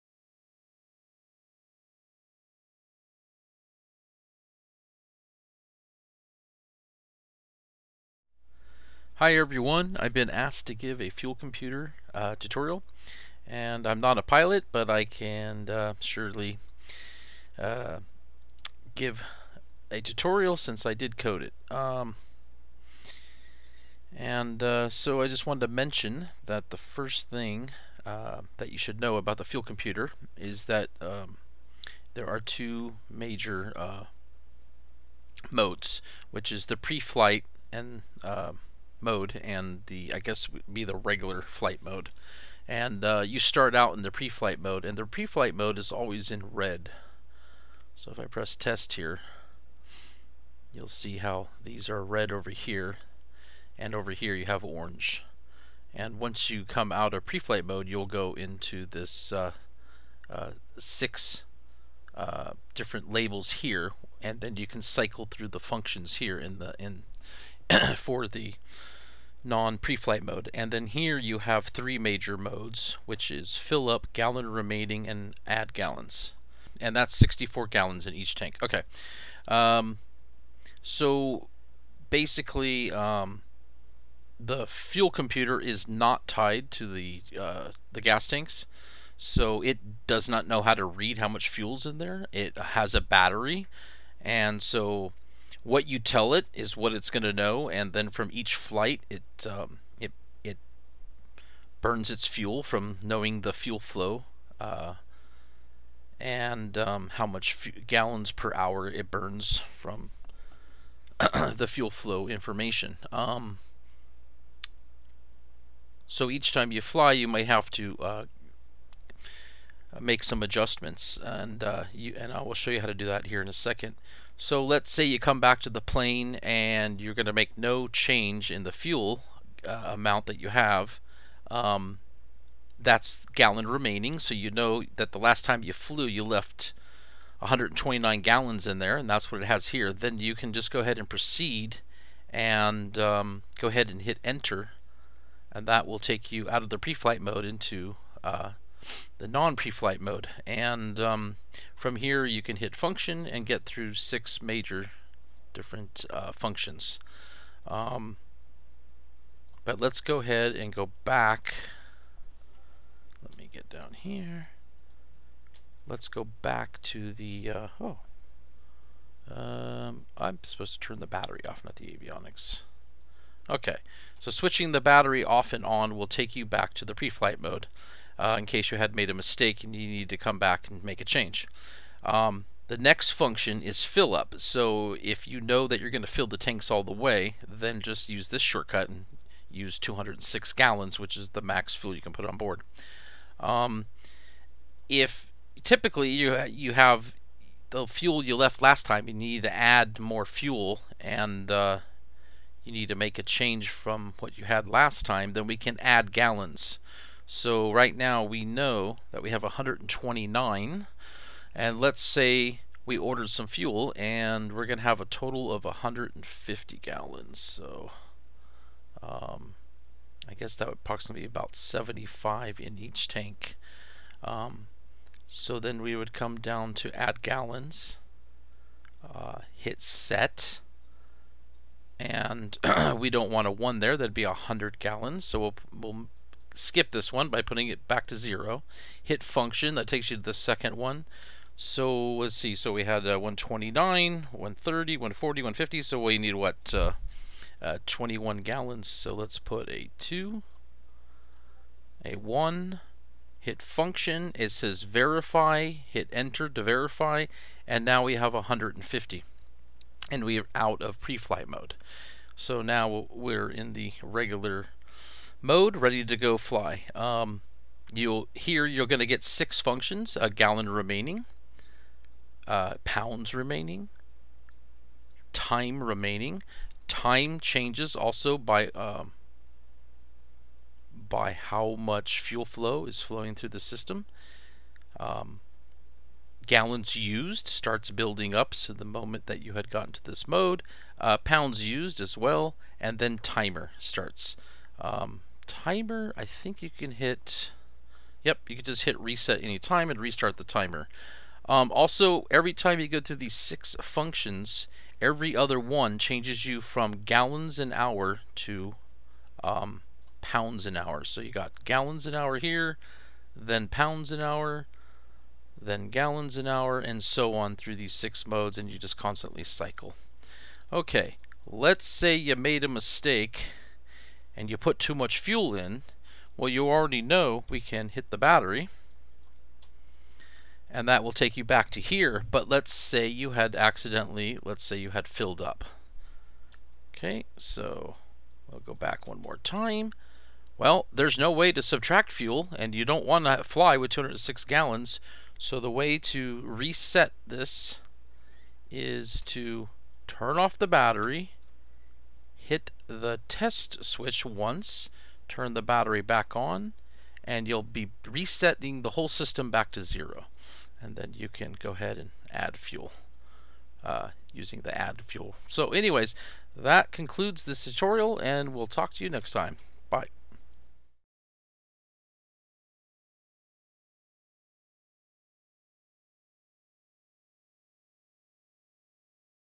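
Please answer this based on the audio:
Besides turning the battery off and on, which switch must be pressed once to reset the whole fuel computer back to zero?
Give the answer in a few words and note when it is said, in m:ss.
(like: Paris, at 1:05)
test switch, at 5:53.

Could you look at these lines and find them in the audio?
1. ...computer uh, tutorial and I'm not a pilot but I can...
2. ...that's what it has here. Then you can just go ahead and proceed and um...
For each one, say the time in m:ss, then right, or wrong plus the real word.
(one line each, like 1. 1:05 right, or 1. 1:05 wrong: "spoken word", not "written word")
1. 0:11 right
2. 2:19 right.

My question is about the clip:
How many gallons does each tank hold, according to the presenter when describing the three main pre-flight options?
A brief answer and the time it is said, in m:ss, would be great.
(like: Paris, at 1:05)
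64, at 1:17.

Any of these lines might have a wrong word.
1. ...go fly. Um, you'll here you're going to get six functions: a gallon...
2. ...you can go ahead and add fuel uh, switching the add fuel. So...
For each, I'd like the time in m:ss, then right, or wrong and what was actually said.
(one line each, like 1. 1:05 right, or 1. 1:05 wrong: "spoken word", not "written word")
1. 4:26 right
2. 6:01 wrong: "using", not "switching".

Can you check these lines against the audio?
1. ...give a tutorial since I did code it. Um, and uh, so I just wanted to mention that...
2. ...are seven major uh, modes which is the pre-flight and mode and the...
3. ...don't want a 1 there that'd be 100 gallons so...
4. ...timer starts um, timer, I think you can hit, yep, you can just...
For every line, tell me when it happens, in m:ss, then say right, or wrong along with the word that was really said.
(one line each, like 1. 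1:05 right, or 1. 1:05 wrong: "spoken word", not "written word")
1. 0:18 right
2. 0:32 wrong: "two", not "seven"
3. 3:53 right
4. 4:53 right.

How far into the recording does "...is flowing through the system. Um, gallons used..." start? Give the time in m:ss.
4:42.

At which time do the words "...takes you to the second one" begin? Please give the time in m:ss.
3:59.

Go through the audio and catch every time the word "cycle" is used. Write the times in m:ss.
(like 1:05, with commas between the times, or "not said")
1:04, 5:19.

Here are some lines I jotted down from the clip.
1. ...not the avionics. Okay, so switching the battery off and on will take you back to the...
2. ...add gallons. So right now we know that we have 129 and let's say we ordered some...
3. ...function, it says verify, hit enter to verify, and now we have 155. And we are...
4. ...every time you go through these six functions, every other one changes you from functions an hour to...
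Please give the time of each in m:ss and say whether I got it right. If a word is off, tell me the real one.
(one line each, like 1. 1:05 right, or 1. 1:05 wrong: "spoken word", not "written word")
1. 2:51 right
2. 3:25 right
3. 4:13 wrong: "150", not "155"
4. 5:02 wrong: "gallons", not "functions".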